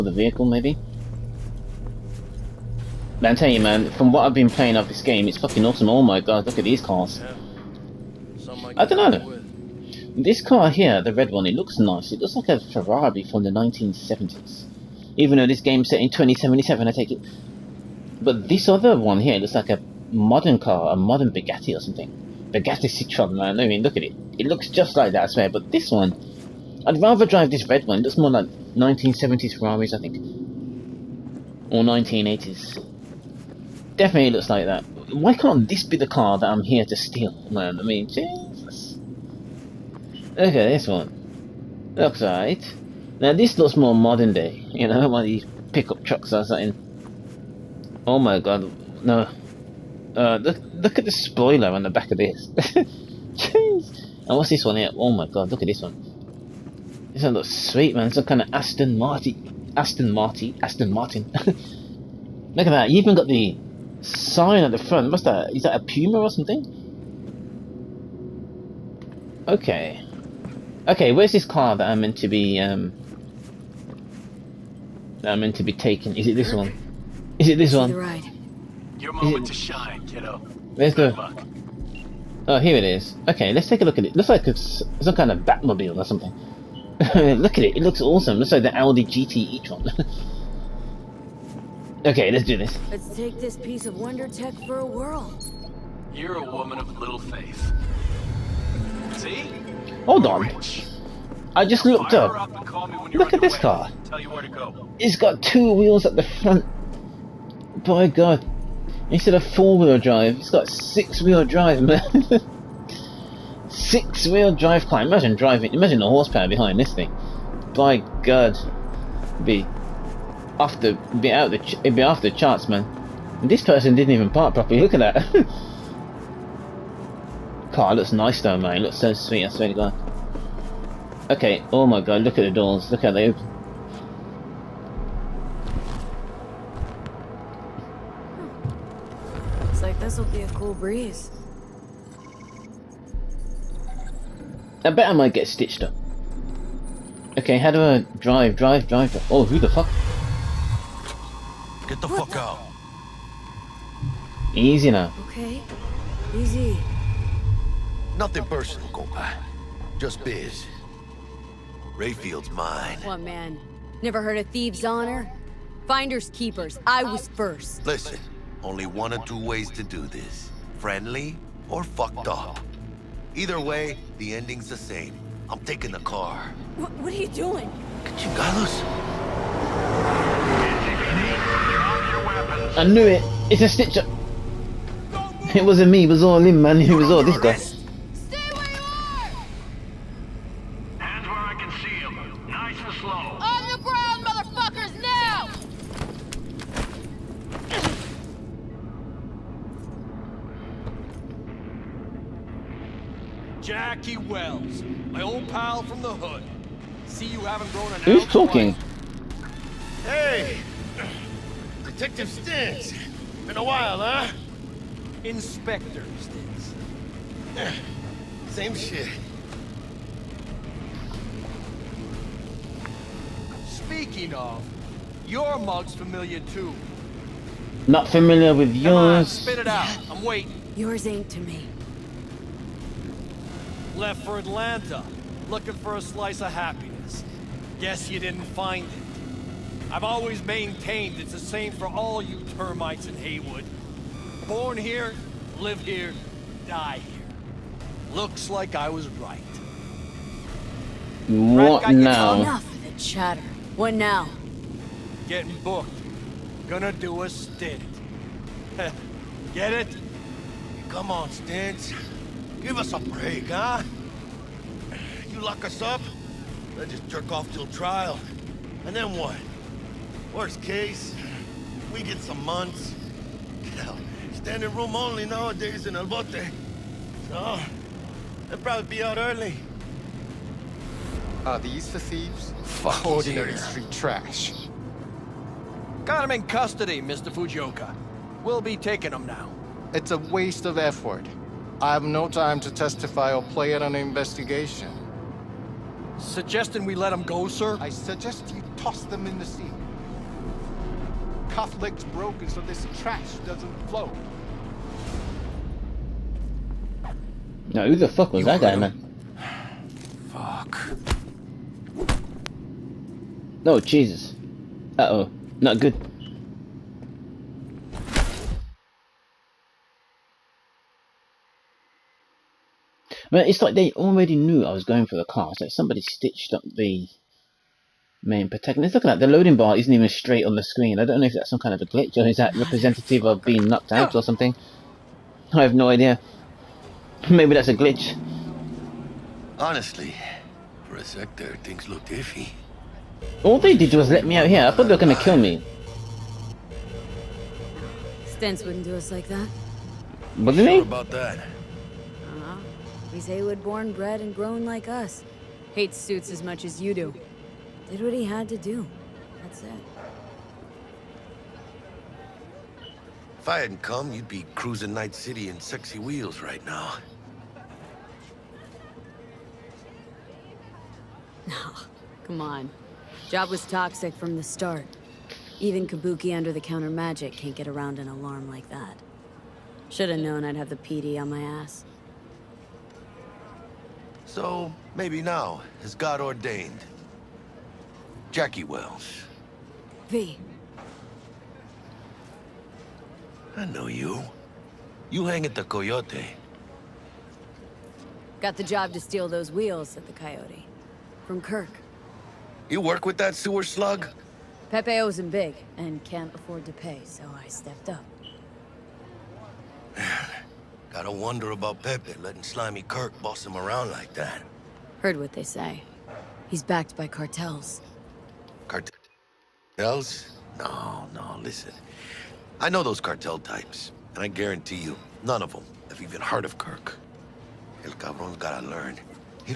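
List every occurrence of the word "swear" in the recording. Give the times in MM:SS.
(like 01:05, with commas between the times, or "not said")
00:25, 02:09.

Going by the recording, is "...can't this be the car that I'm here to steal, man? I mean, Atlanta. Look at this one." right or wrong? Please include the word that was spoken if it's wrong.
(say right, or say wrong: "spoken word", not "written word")
wrong: "Jesus", not "Atlanta".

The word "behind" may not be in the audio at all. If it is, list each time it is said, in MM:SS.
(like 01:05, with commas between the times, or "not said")
01:56.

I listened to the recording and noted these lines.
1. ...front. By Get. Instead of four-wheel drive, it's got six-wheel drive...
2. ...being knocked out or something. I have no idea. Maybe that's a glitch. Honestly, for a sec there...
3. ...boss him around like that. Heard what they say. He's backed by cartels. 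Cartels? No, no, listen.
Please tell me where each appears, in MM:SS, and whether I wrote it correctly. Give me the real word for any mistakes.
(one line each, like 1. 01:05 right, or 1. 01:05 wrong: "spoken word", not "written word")
1. 01:46 wrong: "God", not "Get"
2. 05:33 right
3. 06:53 right.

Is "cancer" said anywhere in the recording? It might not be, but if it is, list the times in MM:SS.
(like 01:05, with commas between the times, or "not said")
not said.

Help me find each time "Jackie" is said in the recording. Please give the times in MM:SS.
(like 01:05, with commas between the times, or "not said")
03:23, 06:28.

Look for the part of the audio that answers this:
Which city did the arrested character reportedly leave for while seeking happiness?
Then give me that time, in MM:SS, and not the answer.
03:54.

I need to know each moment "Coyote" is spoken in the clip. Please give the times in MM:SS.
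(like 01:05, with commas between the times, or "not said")
06:35, 06:40.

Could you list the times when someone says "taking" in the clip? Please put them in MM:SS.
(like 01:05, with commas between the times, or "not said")
01:15, 02:55, 04:48.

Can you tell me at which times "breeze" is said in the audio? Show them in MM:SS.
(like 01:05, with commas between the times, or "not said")
02:20.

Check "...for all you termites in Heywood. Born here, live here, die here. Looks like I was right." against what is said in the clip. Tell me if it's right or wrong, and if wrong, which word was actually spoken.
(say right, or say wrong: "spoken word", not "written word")
right.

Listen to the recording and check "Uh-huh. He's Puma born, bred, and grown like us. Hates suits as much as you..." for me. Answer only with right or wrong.
wrong.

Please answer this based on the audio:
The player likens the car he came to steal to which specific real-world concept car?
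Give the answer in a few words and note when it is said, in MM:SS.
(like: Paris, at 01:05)
Audi GT e-tron, at 01:28.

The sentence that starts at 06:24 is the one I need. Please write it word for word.
So, maybe now, as God ordained.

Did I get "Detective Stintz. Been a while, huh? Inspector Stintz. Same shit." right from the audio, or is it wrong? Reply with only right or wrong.
right.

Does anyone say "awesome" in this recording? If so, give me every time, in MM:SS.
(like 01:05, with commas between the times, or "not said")
00:05, 01:28.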